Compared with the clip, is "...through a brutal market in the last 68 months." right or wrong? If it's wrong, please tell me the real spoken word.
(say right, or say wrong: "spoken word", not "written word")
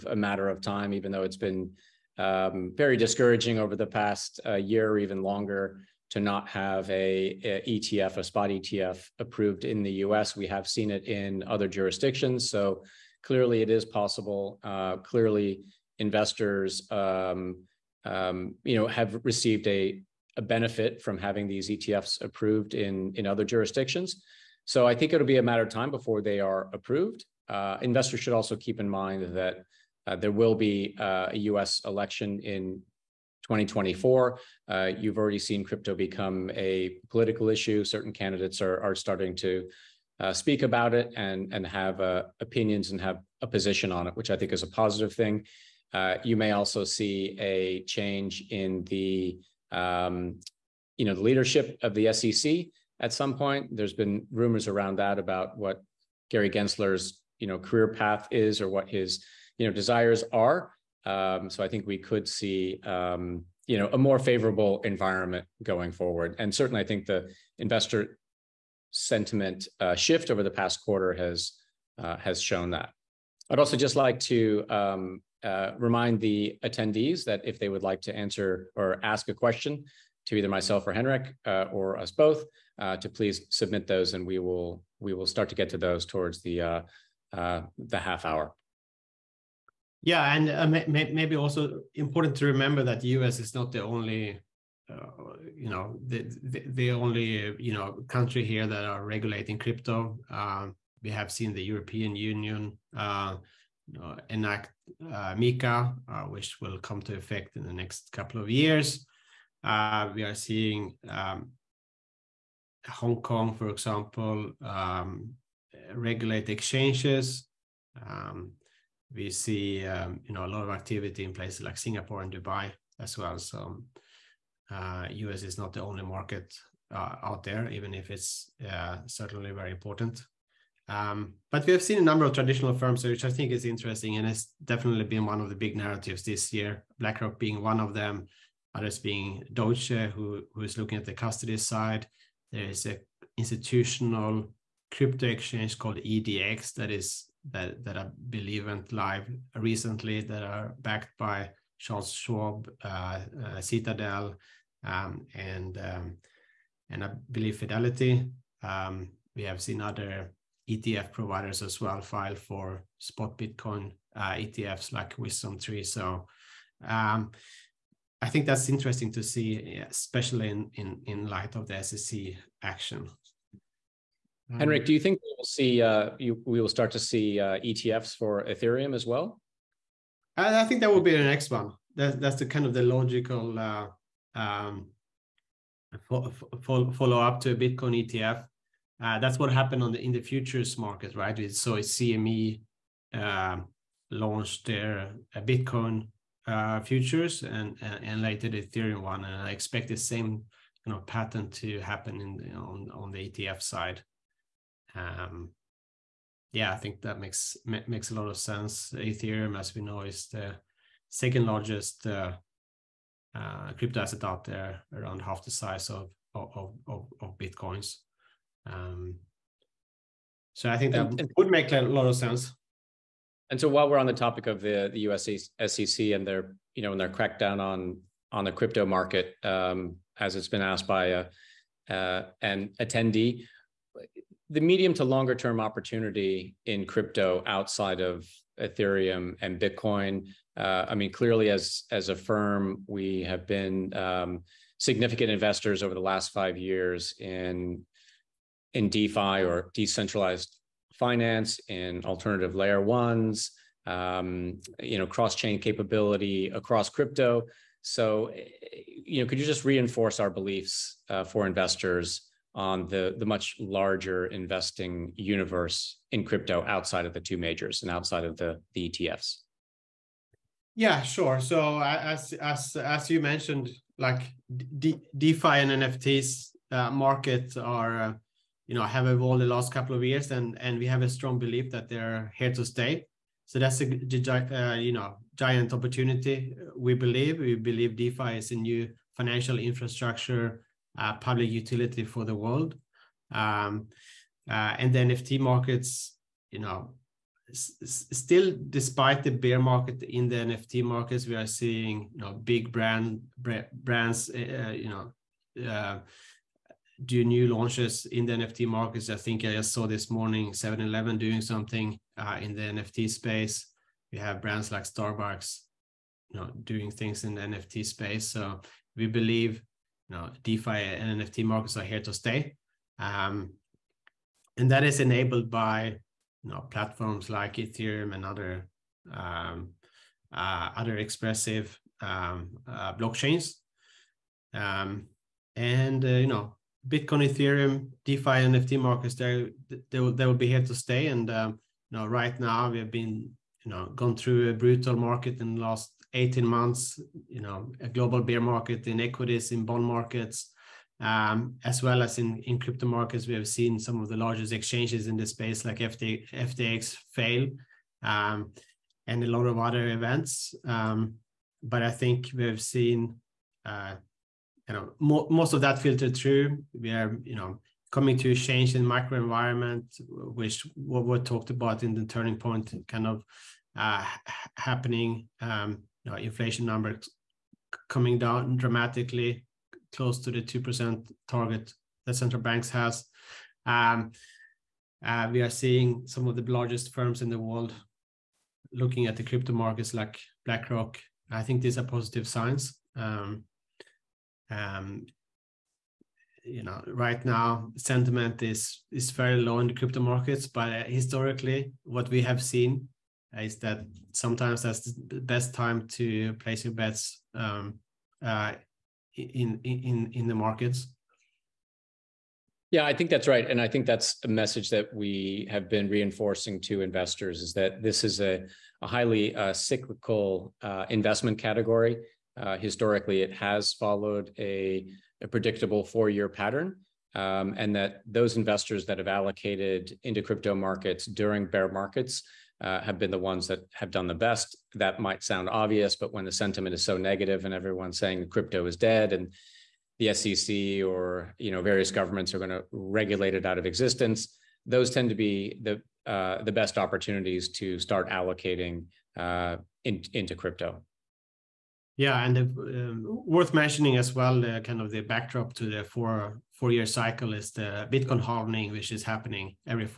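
wrong: "18", not "68".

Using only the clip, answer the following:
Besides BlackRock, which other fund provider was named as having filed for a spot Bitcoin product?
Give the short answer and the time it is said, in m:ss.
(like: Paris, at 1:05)
WisdomTree, at 2:45.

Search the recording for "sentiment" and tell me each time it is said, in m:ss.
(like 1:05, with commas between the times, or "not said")
1:08, 6:37, 7:16.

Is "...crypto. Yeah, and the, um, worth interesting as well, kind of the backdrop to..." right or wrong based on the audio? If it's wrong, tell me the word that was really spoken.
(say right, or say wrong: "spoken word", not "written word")
wrong: "mentioning", not "interesting".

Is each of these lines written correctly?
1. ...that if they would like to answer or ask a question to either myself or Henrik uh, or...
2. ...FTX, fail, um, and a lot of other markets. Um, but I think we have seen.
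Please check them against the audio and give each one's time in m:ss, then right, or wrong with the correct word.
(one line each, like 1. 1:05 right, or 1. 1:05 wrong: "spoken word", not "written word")
1. 1:17 right
2. 5:56 wrong: "events", not "markets".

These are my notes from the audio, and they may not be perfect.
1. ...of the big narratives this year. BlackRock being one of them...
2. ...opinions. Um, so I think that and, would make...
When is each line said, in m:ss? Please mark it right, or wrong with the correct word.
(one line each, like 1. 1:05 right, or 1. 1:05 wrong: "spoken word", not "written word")
1. 2:15 right
2. 3:37 wrong: "bitcoins", not "opinions".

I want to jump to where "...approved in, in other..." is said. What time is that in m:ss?
0:22.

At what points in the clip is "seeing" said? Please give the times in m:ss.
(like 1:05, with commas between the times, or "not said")
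1:50, 5:01, 6:25.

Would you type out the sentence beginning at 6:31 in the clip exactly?
I think these are positive signs.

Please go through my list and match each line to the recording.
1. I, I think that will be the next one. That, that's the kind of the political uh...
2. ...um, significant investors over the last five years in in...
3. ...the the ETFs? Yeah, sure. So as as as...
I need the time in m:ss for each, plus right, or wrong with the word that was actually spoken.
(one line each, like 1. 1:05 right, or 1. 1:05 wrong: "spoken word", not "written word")
1. 3:00 wrong: "logical", not "political"
2. 4:03 right
3. 4:28 right.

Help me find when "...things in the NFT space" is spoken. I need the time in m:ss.
5:16.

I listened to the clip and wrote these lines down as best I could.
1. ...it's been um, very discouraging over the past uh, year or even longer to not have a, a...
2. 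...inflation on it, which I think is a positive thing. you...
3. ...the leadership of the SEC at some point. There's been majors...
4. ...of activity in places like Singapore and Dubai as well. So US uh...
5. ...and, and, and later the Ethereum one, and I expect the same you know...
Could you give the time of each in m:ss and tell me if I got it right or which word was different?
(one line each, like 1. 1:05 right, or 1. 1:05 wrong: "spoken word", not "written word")
1. 0:01 right
2. 0:43 wrong: "position", not "inflation"
3. 0:51 wrong: "rumors", not "majors"
4. 2:00 right
5. 3:17 right.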